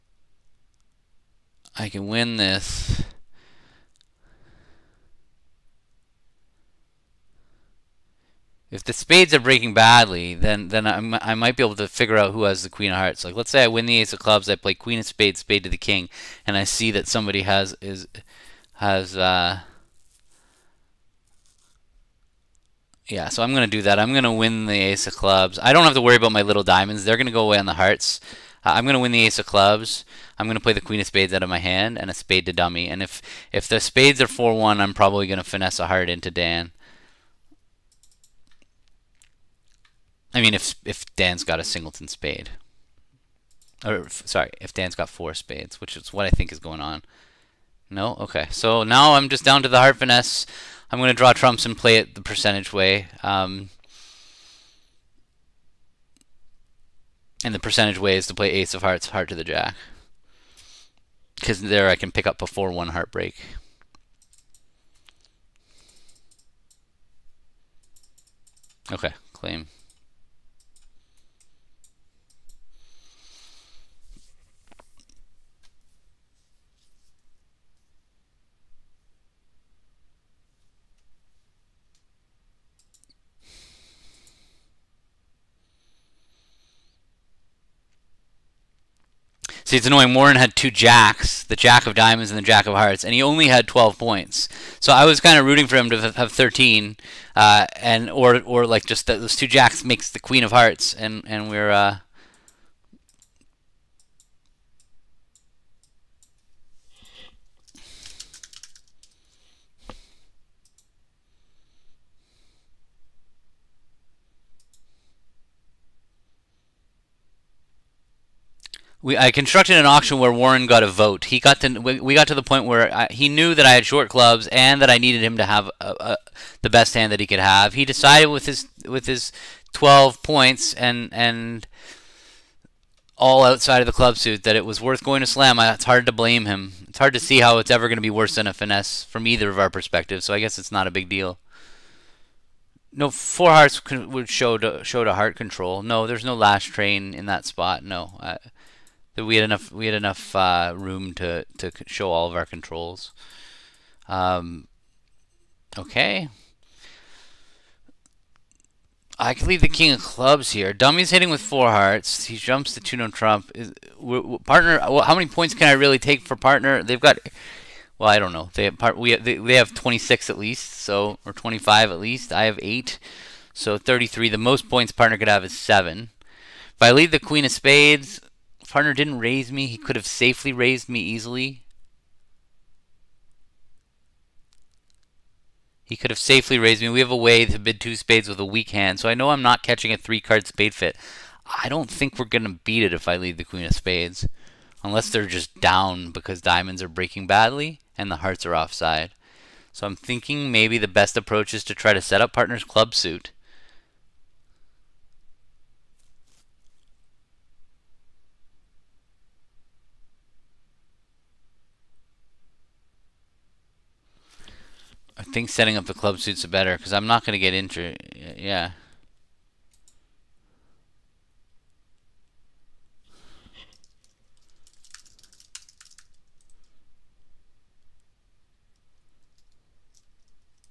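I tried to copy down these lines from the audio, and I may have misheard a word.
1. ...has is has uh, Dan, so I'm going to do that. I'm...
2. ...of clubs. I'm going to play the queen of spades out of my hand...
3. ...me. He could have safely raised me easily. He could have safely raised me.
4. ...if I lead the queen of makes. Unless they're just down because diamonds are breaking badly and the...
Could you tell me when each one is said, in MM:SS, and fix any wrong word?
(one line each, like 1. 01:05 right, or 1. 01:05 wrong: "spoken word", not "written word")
1. 00:17 wrong: "Yeah", not "Dan"
2. 00:29 right
3. 02:59 right
4. 03:12 wrong: "spades", not "makes".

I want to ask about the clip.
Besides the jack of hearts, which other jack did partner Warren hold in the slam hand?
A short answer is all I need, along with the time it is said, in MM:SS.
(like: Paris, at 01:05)
jack of diamonds, at 01:31.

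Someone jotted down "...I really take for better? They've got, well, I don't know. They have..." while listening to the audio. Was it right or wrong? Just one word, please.
wrong.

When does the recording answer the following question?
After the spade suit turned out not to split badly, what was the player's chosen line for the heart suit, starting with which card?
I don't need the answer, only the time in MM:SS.
00:58.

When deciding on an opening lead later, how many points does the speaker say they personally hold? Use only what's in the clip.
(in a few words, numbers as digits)
8.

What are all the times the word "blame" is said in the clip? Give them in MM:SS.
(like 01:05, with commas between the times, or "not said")
02:16.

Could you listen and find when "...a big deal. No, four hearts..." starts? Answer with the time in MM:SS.
02:20.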